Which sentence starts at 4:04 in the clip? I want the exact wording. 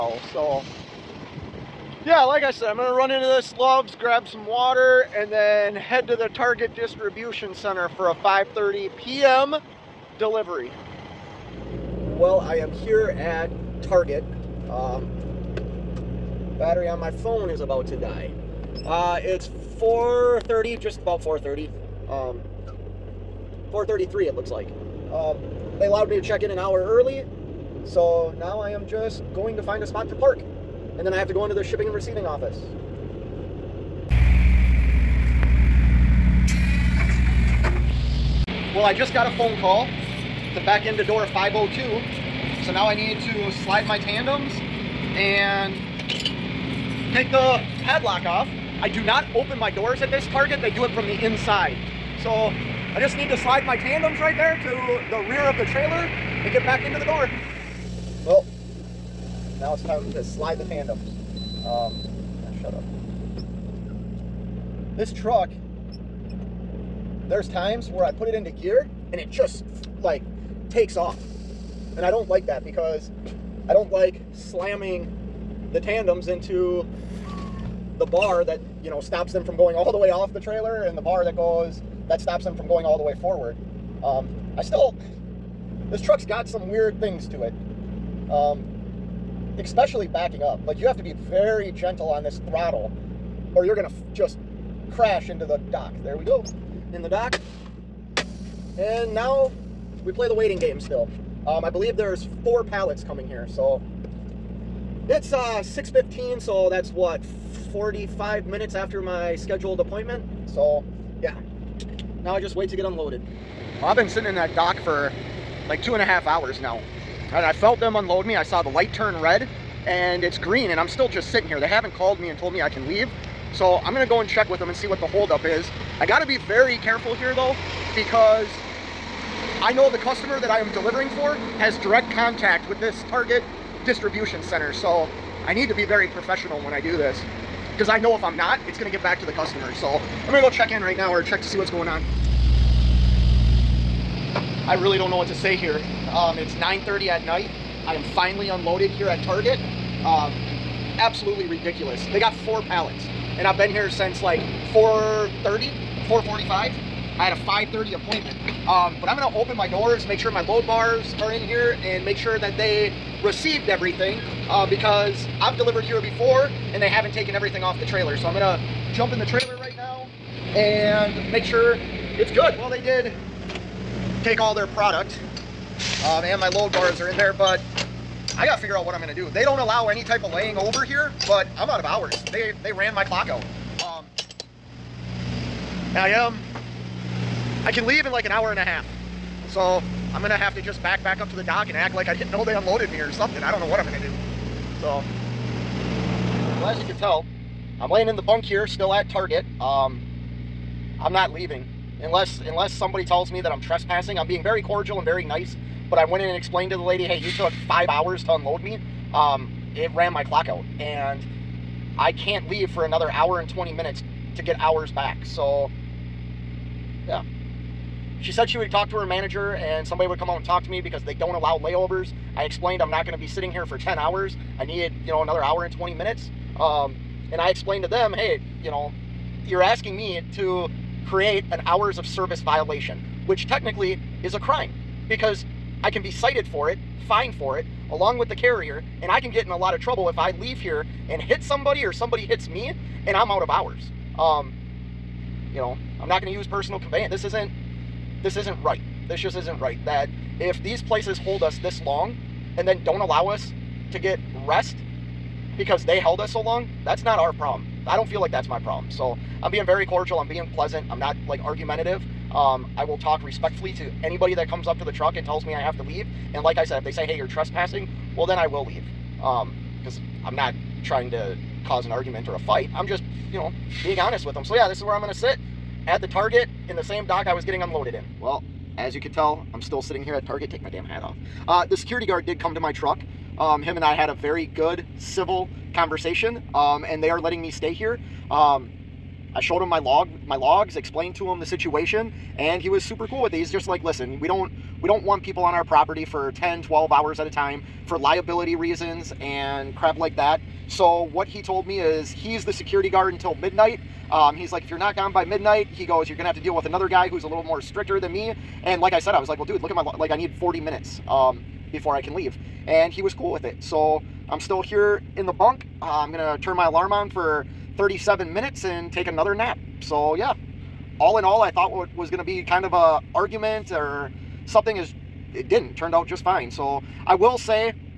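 Um, you know, I'm not going to use personal conveyance.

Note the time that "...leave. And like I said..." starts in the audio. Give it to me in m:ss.
4:25.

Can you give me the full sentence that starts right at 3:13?
I don't know what I'm gonna do.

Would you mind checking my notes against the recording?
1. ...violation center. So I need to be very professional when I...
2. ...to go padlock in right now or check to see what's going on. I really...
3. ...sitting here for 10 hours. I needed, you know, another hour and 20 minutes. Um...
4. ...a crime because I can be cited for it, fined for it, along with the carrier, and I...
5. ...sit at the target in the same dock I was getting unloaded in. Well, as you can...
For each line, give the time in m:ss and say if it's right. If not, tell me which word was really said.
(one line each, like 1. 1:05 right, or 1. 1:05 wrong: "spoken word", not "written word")
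1. 2:13 wrong: "distribution", not "violation"
2. 2:20 wrong: "check", not "padlock"
3. 3:43 right
4. 3:54 right
5. 4:35 right.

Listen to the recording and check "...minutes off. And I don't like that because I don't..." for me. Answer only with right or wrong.
wrong.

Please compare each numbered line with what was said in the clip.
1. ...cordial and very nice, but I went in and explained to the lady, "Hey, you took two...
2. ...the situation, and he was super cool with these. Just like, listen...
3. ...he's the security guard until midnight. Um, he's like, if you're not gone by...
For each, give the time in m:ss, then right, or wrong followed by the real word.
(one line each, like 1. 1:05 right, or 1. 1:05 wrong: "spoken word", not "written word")
1. 3:24 wrong: "five", not "two"
2. 4:51 right
3. 5:02 right.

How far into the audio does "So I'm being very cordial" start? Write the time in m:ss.
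4:18.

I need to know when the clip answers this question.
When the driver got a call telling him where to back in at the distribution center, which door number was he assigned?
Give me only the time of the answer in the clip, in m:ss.
0:41.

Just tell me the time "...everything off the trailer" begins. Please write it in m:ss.
2:47.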